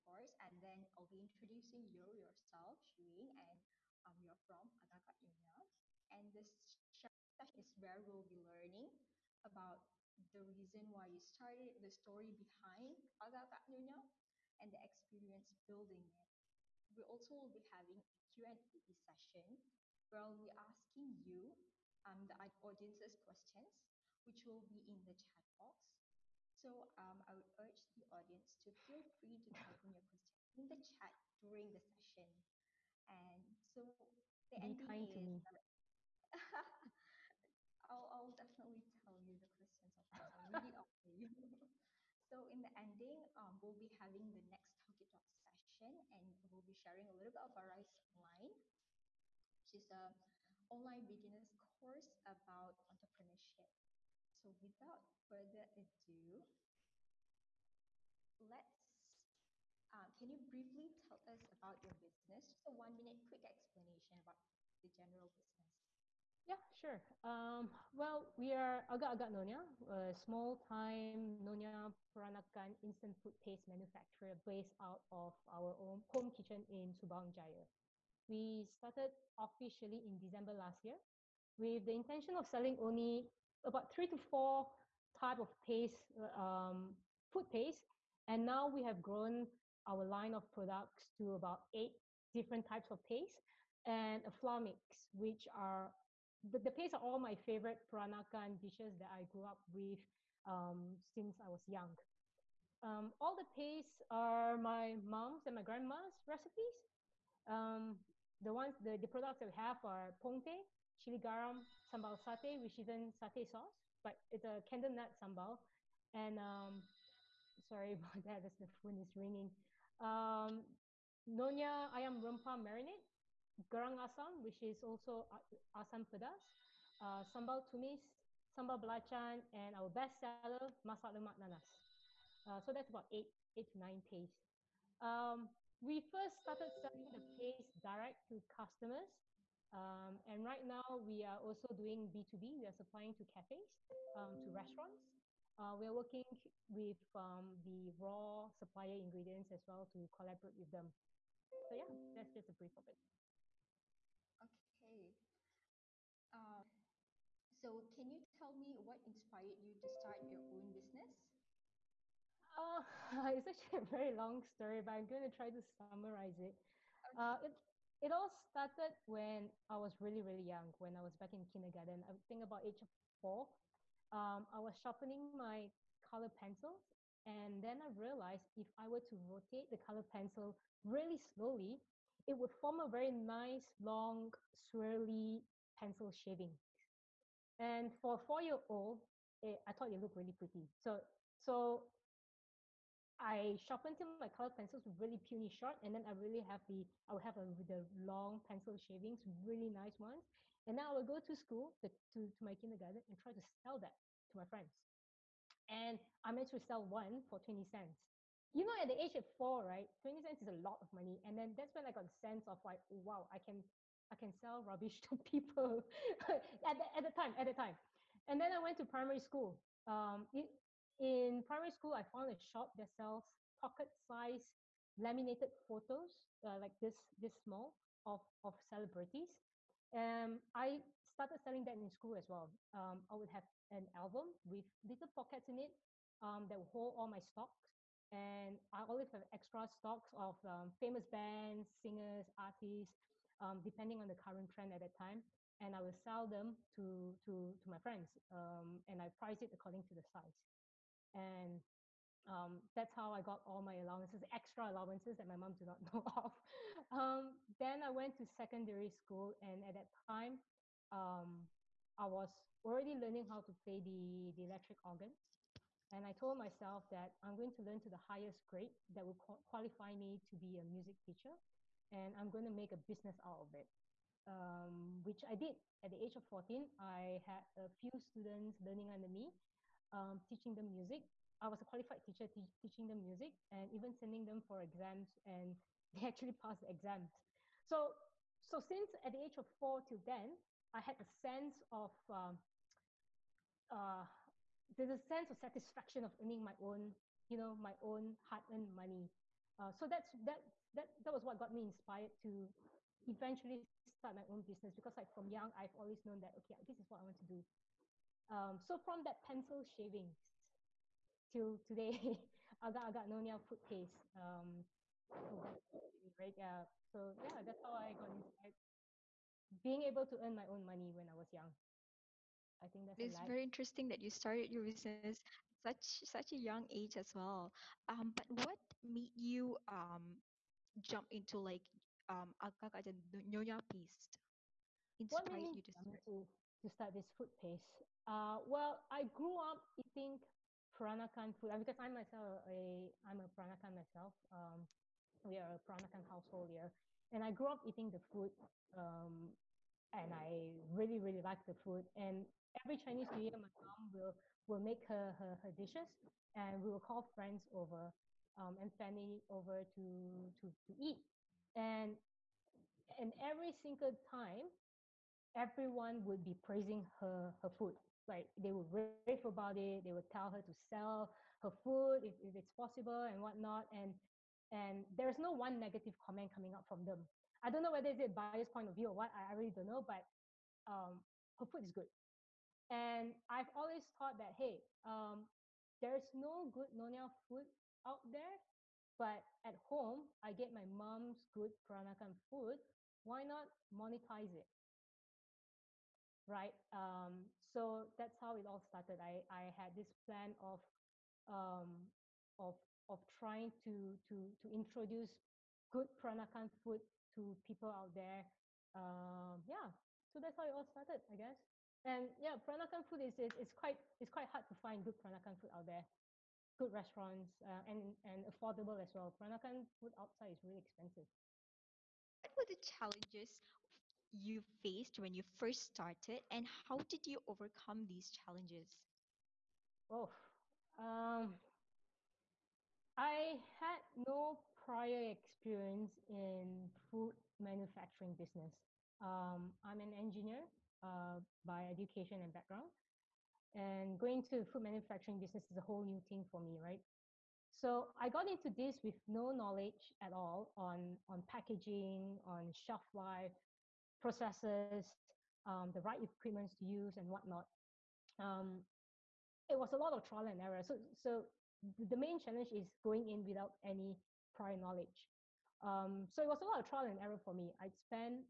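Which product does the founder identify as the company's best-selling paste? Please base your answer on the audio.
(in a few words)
masak lemak nanas.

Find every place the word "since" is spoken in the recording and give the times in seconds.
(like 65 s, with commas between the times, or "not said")
101 s, 288 s.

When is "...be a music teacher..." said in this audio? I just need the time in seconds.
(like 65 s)
270 s.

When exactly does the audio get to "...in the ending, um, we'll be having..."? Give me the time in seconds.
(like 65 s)
42 s.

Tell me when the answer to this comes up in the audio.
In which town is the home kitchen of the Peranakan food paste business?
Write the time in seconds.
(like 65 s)
76 s.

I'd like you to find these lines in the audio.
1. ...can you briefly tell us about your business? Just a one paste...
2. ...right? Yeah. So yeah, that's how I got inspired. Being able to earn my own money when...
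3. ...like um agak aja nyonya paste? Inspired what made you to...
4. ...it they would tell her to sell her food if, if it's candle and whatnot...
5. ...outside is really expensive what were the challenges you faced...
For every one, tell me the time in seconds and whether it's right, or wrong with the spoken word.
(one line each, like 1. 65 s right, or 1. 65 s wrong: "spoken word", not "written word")
1. 60 s wrong: "minute", not "paste"
2. 316 s right
3. 331 s right
4. 369 s wrong: "possible", not "candle"
5. 419 s right.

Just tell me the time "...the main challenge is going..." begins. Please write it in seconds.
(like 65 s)
461 s.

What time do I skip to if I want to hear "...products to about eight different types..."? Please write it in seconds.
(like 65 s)
90 s.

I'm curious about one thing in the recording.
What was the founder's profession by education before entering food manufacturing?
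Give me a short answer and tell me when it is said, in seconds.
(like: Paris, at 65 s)
engineer, at 439 s.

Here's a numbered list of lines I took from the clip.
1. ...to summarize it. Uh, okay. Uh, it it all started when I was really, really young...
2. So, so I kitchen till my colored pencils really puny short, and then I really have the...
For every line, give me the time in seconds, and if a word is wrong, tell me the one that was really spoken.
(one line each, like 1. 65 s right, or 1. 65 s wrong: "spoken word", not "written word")
1. 165 s right
2. 190 s wrong: "sharpen", not "kitchen".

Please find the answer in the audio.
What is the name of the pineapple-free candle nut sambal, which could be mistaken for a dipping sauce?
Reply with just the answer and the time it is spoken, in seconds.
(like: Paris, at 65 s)
sambal satay, at 111 s.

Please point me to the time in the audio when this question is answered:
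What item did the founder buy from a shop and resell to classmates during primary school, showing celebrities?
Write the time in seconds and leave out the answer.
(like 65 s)
224 s.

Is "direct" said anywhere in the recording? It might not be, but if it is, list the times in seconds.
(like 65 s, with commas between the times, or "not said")
137 s.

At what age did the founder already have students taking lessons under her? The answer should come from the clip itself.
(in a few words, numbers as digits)
14.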